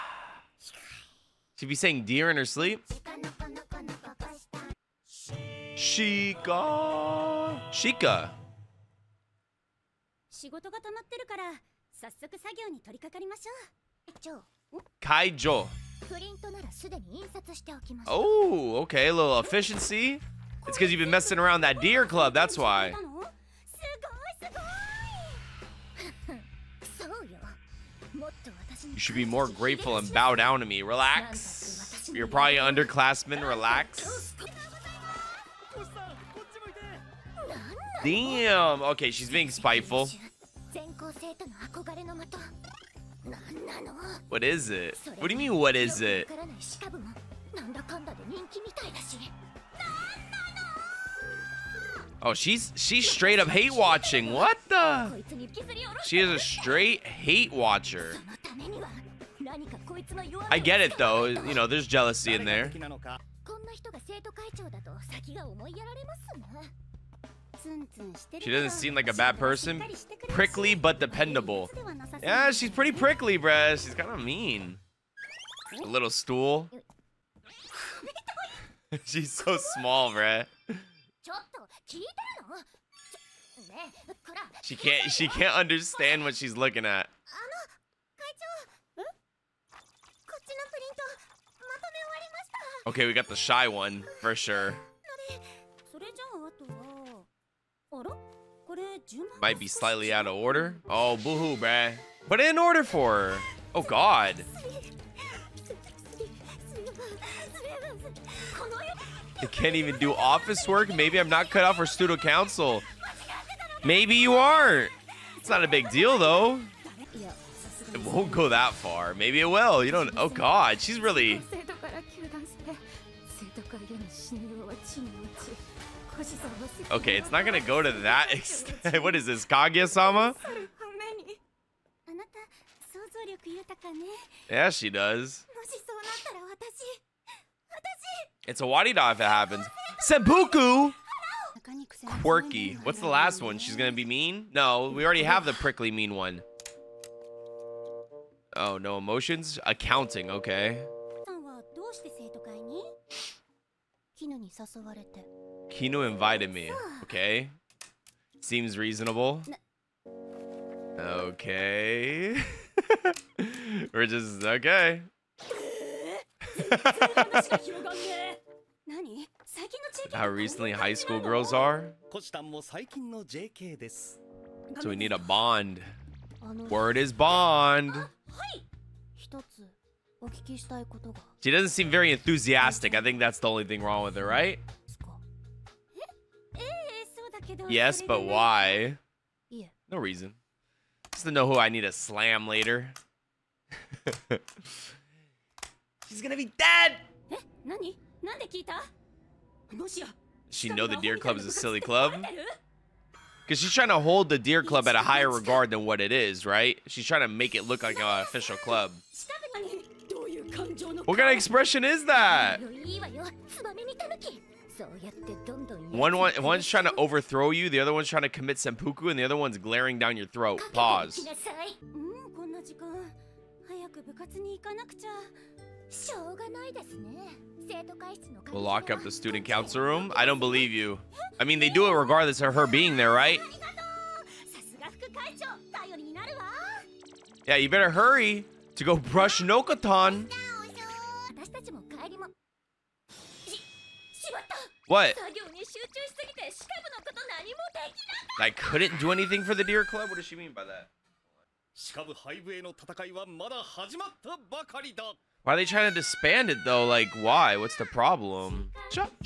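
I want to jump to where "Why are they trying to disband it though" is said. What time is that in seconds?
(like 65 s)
255 s.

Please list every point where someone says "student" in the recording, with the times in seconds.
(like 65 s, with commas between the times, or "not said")
111 s, 229 s.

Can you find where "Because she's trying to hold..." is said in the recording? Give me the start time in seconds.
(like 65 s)
203 s.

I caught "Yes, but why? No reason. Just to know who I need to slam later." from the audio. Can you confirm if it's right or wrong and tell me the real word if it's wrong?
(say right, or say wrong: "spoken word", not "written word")
right.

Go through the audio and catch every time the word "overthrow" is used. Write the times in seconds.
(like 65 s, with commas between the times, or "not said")
216 s.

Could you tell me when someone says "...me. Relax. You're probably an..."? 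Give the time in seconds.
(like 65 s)
30 s.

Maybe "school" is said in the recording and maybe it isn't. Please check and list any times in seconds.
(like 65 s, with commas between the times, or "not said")
170 s.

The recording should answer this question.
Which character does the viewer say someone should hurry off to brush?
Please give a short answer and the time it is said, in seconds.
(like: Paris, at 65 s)
Nokotan, at 239 s.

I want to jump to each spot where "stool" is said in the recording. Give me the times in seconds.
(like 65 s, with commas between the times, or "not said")
76 s.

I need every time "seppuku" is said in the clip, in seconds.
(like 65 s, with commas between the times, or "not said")
139 s, 218 s.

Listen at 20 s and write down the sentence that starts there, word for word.
It's because you've been messing around that deer club, that's why.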